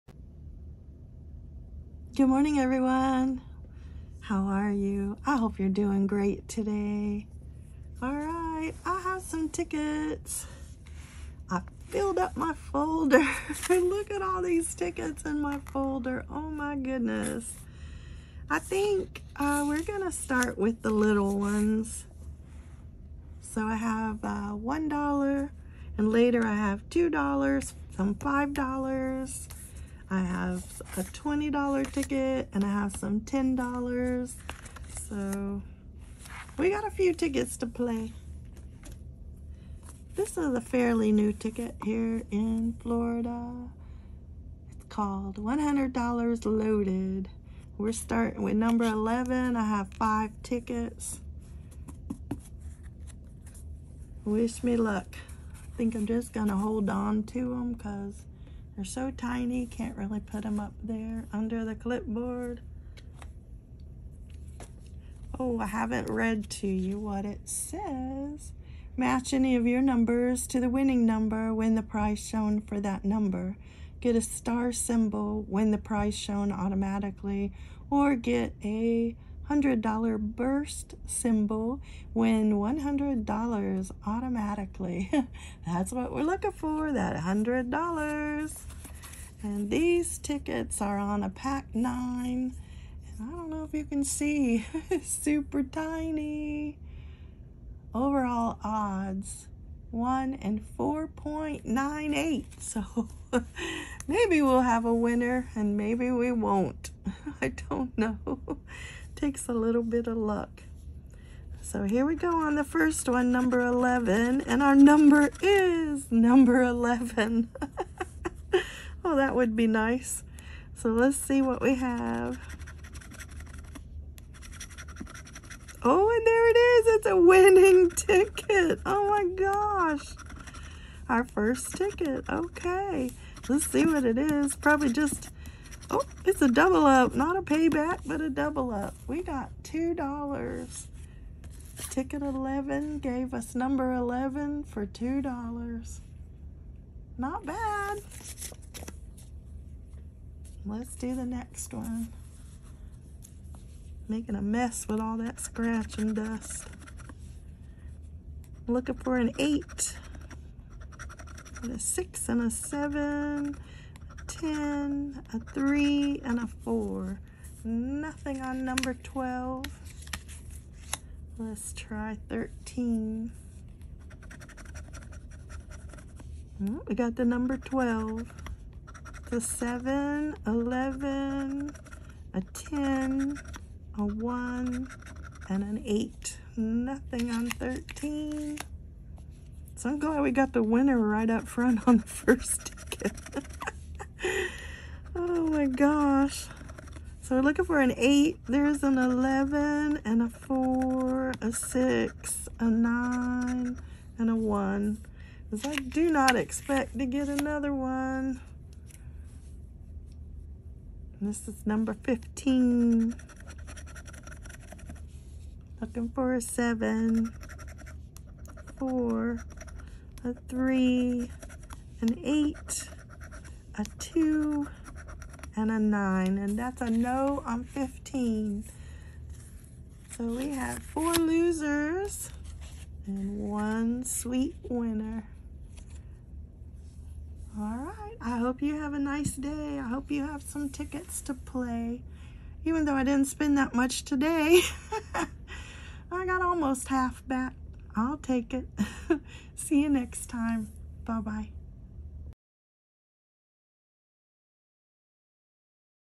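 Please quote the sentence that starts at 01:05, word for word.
Oh, I haven't read to you what it says.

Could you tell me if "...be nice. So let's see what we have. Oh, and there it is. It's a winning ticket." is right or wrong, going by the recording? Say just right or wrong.
right.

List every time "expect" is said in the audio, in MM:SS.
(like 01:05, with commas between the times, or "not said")
03:26.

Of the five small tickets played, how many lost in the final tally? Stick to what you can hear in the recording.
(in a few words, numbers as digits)
4.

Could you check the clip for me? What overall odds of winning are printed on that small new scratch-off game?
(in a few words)
1 in 4.98.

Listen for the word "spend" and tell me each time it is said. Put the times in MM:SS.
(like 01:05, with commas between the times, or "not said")
04:03.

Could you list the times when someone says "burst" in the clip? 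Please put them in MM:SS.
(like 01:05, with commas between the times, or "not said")
01:20.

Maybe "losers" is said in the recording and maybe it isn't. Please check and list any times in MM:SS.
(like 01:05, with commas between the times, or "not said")
03:51.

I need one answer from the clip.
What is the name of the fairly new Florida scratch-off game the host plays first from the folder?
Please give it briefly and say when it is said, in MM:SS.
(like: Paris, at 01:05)
$100 Loaded, at 00:45.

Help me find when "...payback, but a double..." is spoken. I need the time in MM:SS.
02:17.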